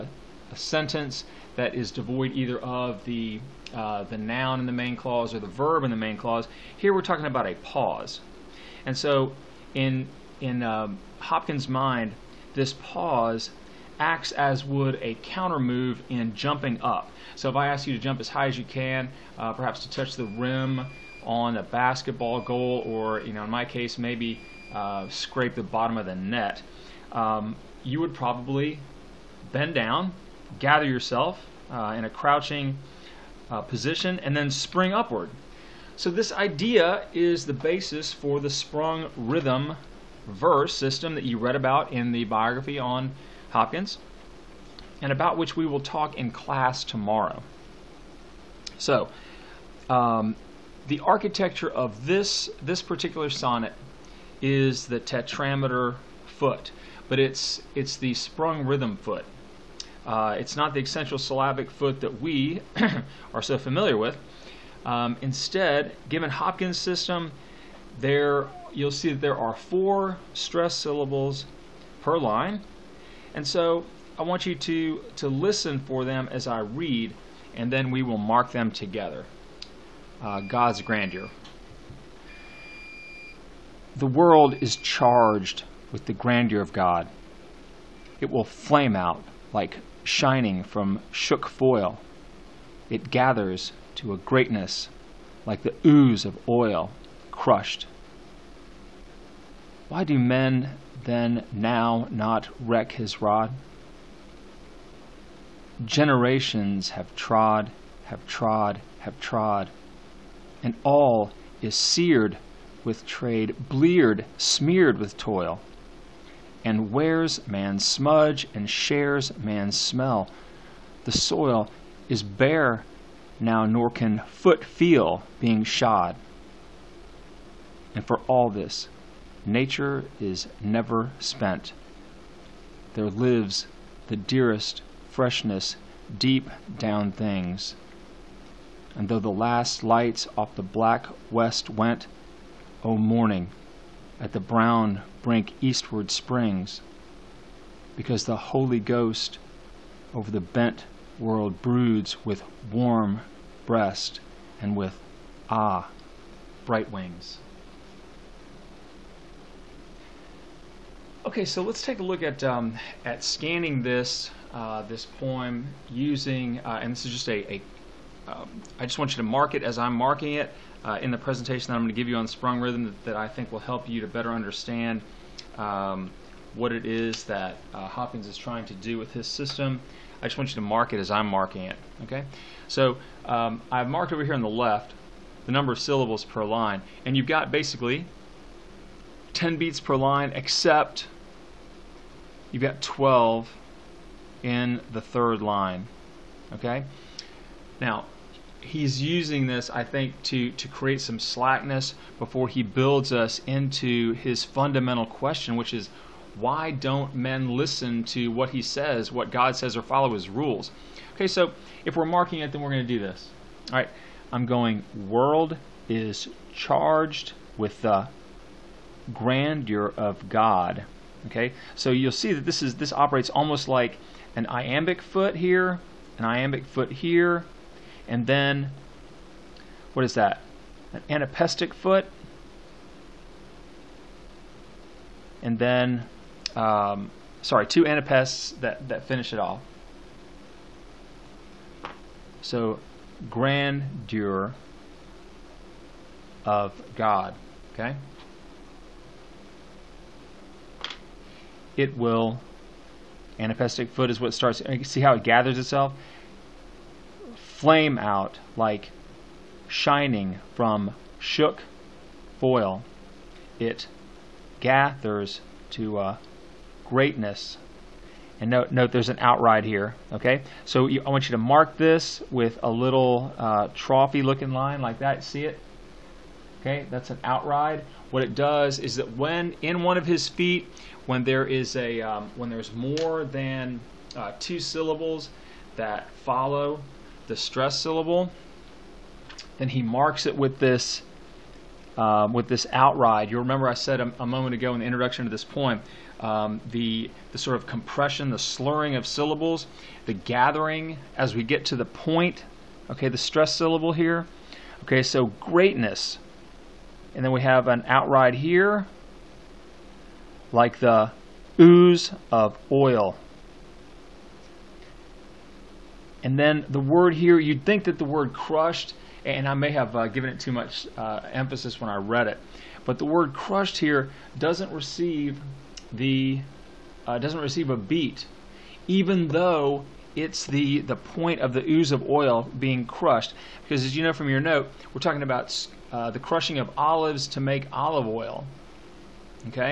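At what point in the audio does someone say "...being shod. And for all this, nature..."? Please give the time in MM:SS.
02:05.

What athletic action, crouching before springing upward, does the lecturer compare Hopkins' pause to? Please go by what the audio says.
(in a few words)
jumping up.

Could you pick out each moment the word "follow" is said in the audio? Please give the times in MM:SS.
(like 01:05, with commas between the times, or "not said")
03:29, 04:46.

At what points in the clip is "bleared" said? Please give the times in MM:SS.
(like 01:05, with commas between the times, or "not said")
01:53.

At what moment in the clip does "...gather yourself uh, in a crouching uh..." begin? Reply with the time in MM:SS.
00:30.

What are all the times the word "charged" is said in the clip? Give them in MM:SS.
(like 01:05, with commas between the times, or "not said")
01:24, 03:36.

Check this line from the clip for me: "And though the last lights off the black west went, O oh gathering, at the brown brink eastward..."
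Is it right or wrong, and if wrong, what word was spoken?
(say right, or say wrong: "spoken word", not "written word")
wrong: "morning", not "gathering".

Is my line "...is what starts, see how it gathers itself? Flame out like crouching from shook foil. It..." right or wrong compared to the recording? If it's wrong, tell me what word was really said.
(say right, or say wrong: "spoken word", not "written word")
wrong: "shining", not "crouching".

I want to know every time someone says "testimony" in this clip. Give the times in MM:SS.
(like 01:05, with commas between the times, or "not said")
not said.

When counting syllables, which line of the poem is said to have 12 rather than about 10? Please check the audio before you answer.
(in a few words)
the third line.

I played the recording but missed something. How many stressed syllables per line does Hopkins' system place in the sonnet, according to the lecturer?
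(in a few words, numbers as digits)
4.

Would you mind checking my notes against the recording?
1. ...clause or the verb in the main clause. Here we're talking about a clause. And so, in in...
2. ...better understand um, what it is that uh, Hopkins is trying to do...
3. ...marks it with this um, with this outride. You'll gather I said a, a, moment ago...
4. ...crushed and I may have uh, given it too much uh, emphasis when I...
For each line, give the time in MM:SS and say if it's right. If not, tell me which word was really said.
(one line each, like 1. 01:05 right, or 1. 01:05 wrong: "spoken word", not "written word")
1. 00:04 wrong: "pause", not "clause"
2. 02:54 right
3. 04:49 wrong: "remember", not "gather"
4. 05:18 right.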